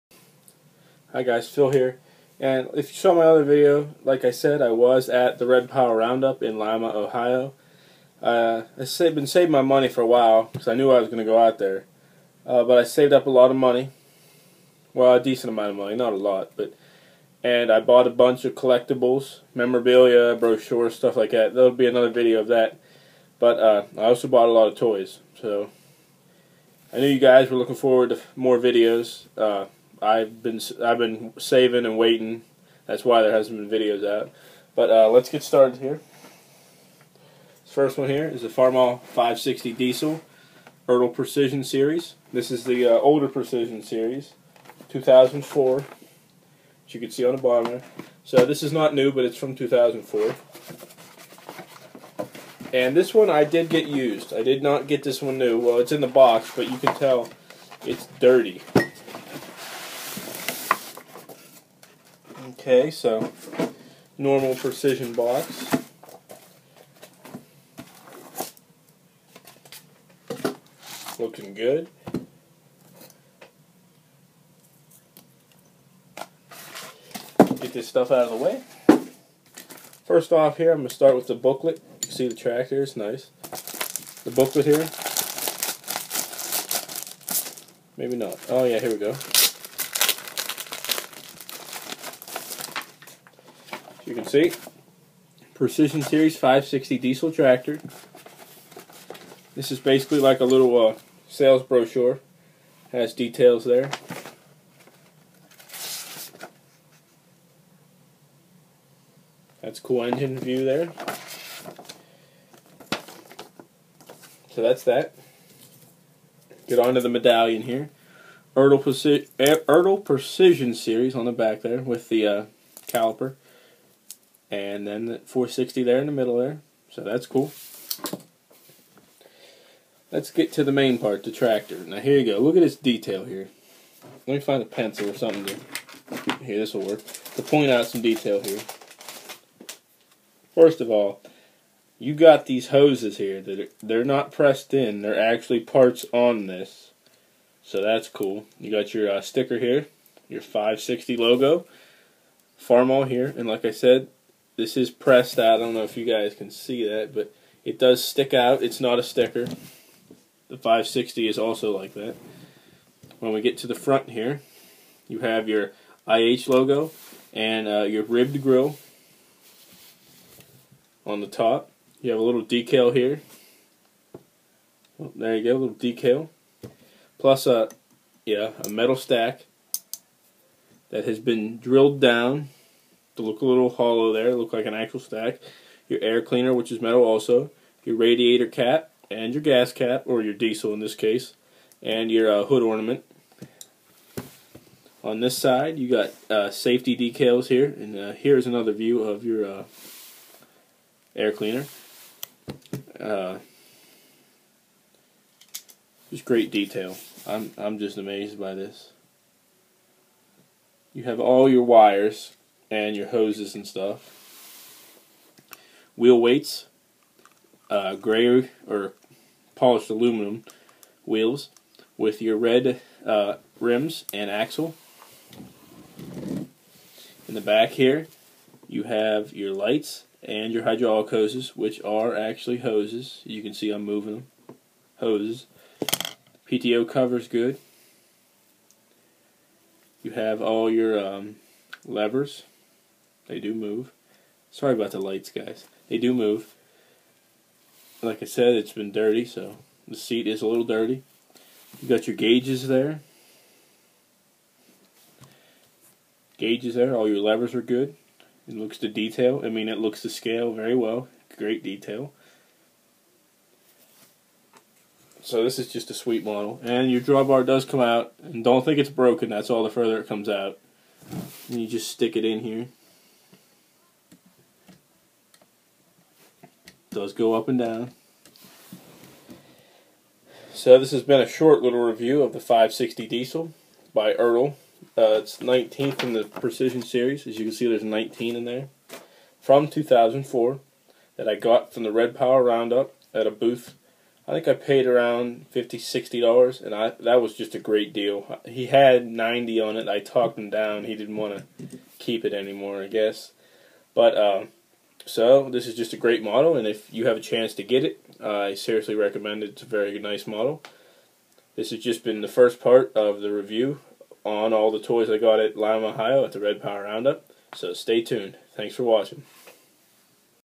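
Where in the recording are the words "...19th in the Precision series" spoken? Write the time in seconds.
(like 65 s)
285 s.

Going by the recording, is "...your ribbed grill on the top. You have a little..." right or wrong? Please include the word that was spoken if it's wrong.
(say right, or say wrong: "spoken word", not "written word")
right.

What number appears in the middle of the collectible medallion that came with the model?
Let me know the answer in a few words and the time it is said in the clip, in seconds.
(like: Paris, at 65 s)
460, at 125 s.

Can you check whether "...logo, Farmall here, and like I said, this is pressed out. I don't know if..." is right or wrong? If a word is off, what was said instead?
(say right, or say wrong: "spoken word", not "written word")
right.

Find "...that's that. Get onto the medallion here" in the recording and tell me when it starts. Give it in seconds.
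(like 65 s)
114 s.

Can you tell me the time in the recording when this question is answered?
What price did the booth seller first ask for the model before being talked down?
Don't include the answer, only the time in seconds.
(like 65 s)
299 s.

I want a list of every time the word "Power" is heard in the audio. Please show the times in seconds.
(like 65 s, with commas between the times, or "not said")
5 s, 292 s, 316 s.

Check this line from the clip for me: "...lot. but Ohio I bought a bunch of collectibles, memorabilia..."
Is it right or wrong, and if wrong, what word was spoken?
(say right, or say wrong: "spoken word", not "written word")
wrong: "And", not "Ohio".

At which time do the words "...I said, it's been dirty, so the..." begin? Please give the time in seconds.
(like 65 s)
248 s.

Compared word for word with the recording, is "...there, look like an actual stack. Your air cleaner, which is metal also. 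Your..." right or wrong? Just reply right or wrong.
right.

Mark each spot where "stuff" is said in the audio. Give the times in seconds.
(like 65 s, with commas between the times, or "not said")
20 s, 77 s, 213 s.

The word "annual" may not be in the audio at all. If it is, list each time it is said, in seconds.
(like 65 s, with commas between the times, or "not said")
not said.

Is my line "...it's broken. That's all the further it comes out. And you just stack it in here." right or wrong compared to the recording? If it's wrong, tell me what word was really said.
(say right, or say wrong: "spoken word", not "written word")
wrong: "stick", not "stack".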